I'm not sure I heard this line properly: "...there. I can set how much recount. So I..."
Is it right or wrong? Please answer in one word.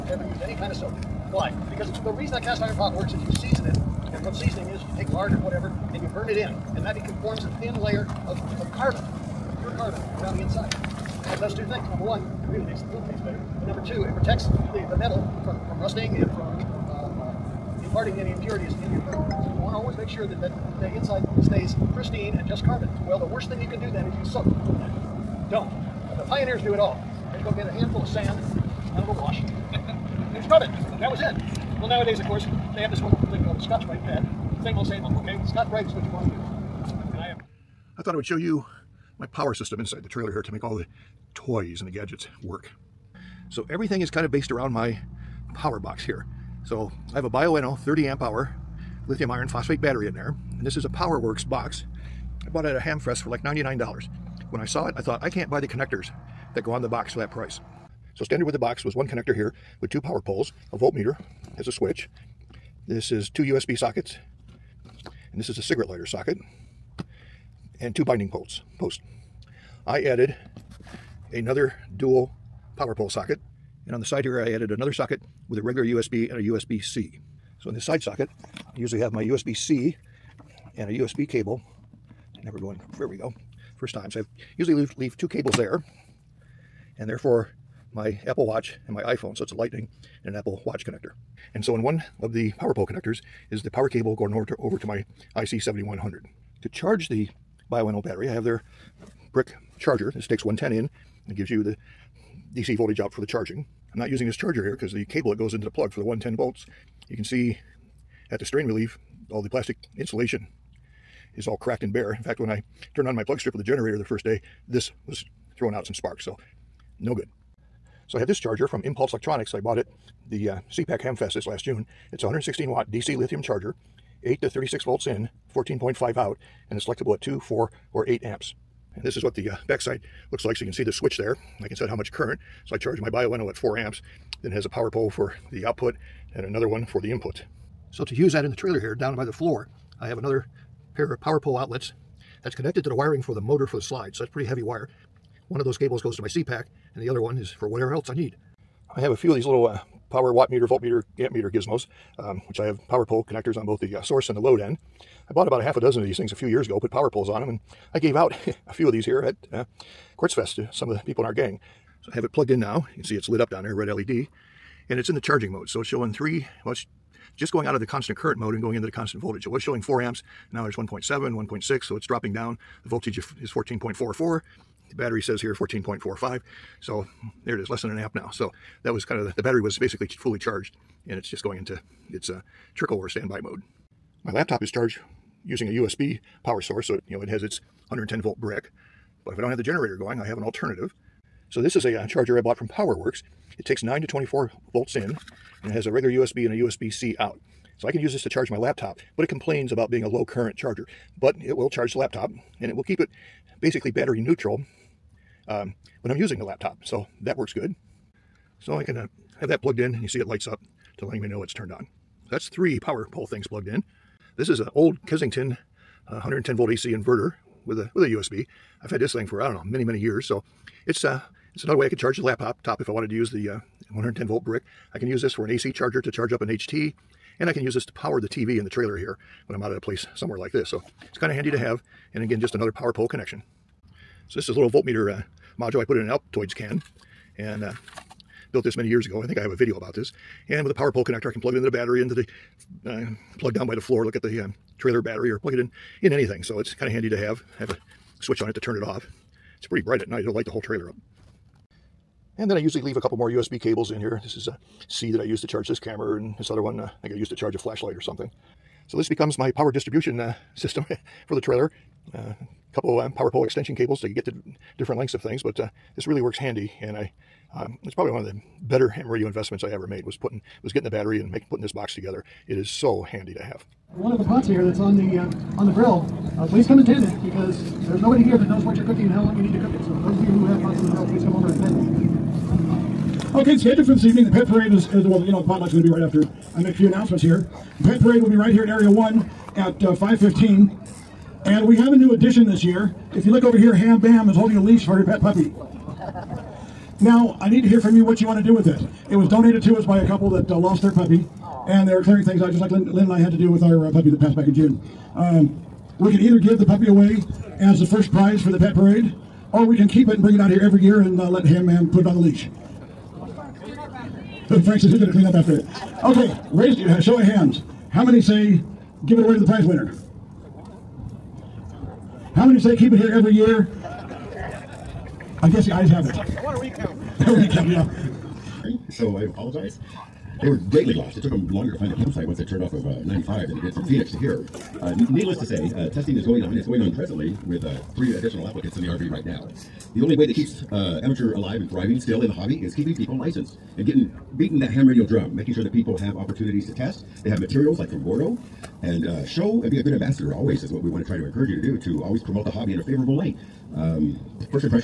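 wrong.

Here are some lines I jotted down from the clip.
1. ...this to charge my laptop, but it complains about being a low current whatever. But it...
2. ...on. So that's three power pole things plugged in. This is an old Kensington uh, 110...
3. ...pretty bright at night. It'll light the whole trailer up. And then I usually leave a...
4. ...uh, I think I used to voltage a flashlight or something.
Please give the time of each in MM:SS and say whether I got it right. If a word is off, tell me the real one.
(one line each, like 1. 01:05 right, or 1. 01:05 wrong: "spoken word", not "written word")
1. 03:18 wrong: "charger", not "whatever"
2. 03:31 right
3. 04:09 right
4. 04:16 wrong: "charge", not "voltage".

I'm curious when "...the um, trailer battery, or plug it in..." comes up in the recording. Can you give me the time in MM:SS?
04:04.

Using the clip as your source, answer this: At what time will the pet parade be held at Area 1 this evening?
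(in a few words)
5:15.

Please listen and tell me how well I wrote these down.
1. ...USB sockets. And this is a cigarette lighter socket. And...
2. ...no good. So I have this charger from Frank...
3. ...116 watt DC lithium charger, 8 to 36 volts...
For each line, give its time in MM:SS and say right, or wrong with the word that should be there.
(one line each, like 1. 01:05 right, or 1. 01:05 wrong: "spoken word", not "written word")
1. 01:03 right
2. 01:56 wrong: "Impulse", not "Frank"
3. 02:02 right.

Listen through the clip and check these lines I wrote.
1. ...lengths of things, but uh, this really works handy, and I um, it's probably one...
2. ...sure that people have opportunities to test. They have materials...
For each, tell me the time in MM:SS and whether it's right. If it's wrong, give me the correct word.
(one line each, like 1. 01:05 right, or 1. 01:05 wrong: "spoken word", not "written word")
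1. 04:24 right
2. 05:45 right.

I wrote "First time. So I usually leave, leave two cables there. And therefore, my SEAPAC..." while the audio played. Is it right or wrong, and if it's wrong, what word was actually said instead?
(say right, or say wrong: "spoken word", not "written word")
wrong: "Apple", not "SEAPAC".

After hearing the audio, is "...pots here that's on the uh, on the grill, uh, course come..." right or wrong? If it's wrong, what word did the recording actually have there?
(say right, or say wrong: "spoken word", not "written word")
wrong: "please", not "course".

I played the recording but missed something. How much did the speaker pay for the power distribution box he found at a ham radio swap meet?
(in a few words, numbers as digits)
$99.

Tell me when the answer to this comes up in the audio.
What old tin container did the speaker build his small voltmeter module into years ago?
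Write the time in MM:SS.
03:56.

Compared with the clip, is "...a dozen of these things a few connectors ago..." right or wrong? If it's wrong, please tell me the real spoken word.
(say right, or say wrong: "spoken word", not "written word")
wrong: "years", not "connectors".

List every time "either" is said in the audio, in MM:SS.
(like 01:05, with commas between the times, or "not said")
05:06.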